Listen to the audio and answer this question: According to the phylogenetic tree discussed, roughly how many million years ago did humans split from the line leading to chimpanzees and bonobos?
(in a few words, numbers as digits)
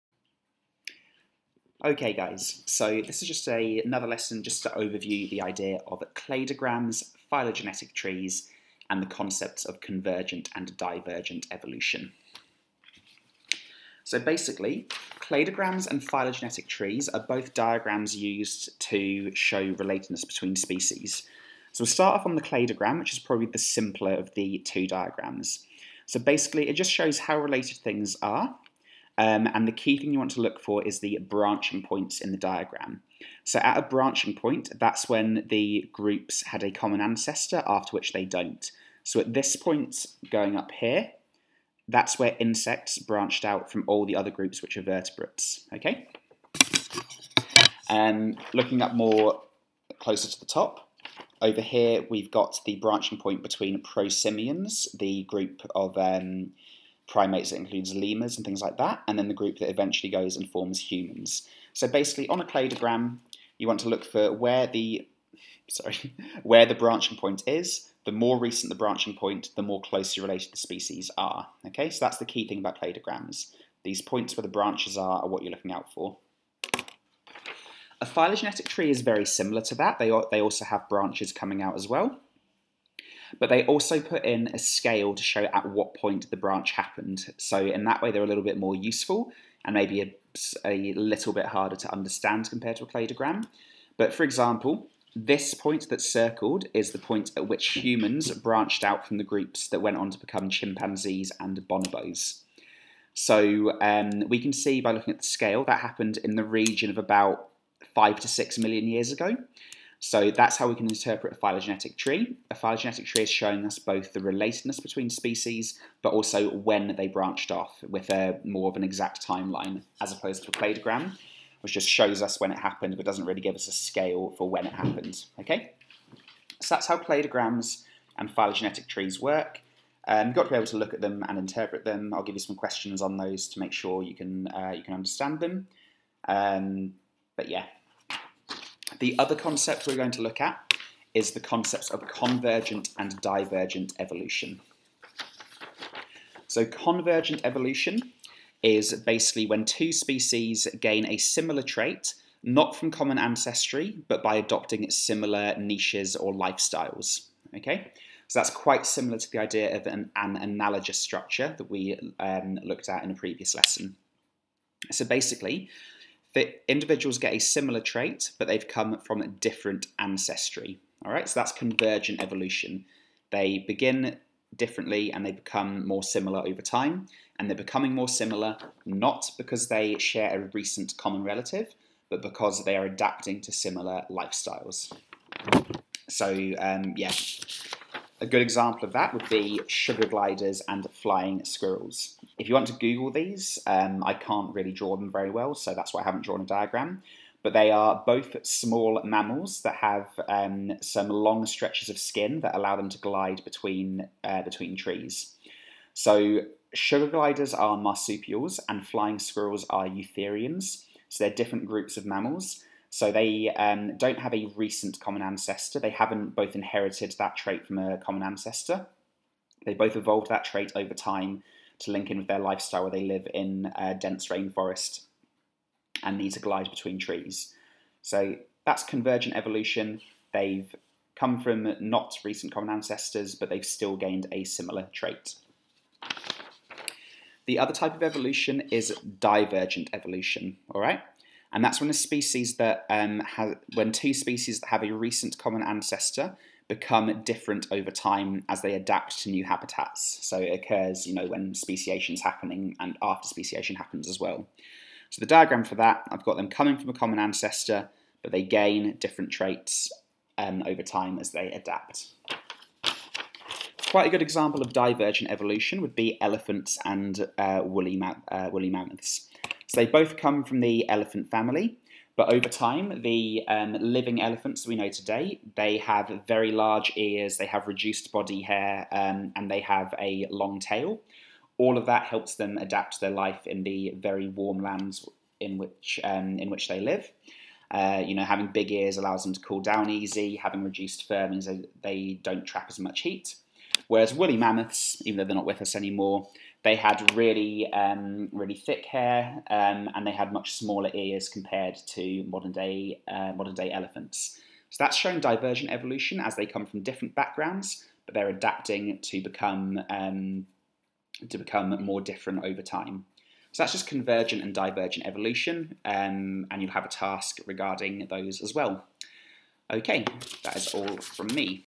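5 to 6.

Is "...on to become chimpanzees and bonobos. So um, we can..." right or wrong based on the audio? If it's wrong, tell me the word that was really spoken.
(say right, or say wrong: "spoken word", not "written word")
right.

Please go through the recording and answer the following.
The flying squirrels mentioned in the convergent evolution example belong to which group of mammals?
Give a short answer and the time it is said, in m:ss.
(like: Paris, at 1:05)
Eutherians, at 3:29.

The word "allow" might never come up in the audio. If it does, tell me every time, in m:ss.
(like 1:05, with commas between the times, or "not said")
3:22, 4:48.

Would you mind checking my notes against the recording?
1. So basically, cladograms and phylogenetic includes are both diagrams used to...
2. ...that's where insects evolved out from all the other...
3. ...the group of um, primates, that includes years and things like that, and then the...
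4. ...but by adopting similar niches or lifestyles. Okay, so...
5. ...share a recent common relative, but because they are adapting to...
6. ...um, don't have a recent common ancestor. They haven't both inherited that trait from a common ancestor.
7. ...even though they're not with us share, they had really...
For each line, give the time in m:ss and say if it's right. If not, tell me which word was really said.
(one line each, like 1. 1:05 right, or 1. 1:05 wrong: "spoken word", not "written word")
1. 0:14 wrong: "trees", not "includes"
2. 0:41 wrong: "branched", not "evolved"
3. 0:54 wrong: "lemurs", not "years"
4. 2:34 right
5. 2:59 right
6. 3:33 right
7. 4:55 wrong: "anymore", not "share".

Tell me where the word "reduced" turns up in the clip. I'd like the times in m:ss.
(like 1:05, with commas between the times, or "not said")
4:37, 4:50.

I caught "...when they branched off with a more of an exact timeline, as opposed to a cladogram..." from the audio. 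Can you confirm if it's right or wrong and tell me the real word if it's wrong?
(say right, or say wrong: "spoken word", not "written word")
right.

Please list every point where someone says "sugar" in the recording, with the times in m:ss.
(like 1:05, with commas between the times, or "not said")
3:09, 3:26.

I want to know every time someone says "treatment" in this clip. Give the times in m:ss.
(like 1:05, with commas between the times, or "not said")
not said.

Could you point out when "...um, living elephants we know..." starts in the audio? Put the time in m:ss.
4:33.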